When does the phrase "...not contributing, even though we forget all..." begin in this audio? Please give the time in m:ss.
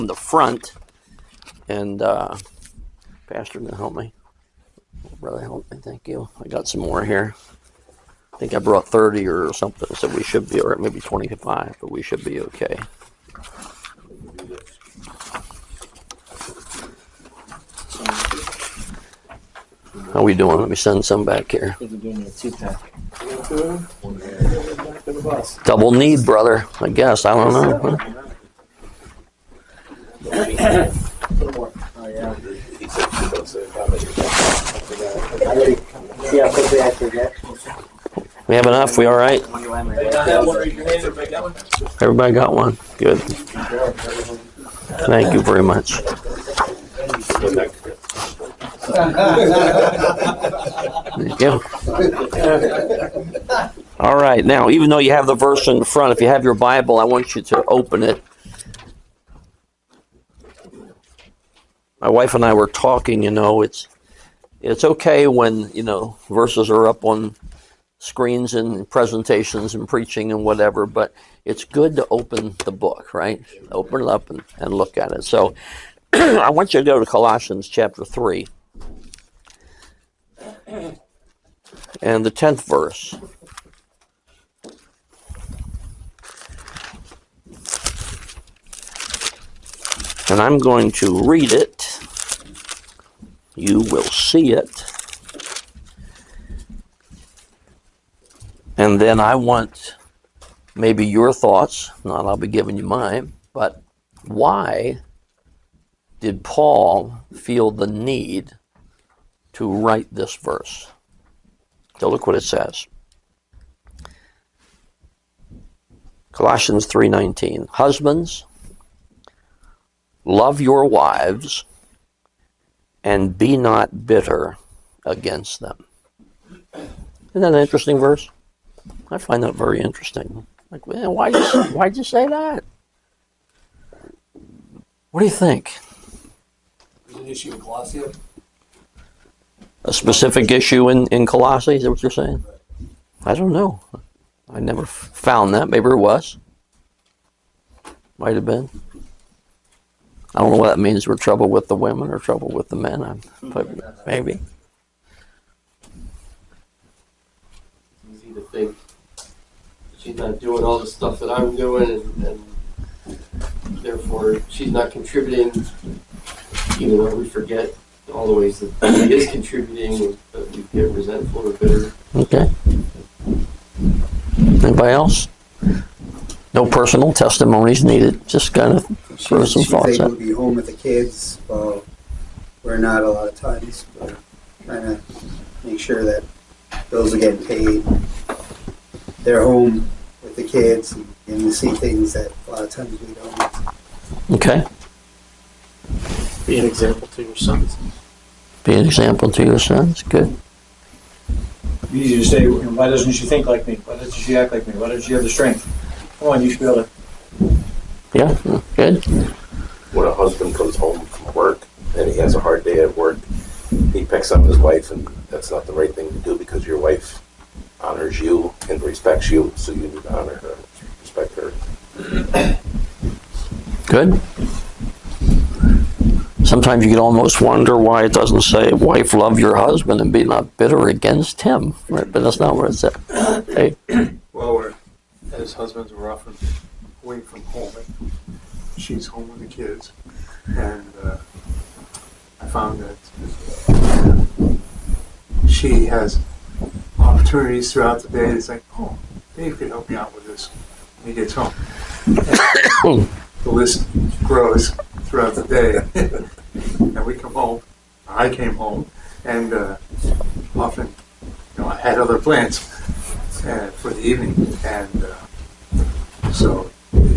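2:44.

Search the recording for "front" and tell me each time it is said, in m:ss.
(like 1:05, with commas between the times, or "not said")
0:00, 0:55.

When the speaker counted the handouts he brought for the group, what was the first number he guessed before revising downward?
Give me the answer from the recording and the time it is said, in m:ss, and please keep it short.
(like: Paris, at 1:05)
30, at 0:08.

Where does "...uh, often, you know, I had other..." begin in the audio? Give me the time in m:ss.
4:19.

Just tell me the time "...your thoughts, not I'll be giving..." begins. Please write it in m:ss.
1:41.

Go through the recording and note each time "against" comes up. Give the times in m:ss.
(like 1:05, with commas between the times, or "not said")
2:05, 3:50.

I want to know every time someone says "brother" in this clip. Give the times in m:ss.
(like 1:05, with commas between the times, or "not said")
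0:05, 0:26.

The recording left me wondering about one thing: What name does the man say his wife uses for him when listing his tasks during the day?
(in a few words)
Dave.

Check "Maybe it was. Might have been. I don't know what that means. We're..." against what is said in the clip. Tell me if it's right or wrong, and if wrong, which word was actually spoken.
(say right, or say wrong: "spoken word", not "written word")
right.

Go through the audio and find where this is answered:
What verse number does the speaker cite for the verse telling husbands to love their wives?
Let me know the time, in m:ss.
1:56.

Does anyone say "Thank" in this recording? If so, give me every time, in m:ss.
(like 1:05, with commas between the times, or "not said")
0:05, 0:44.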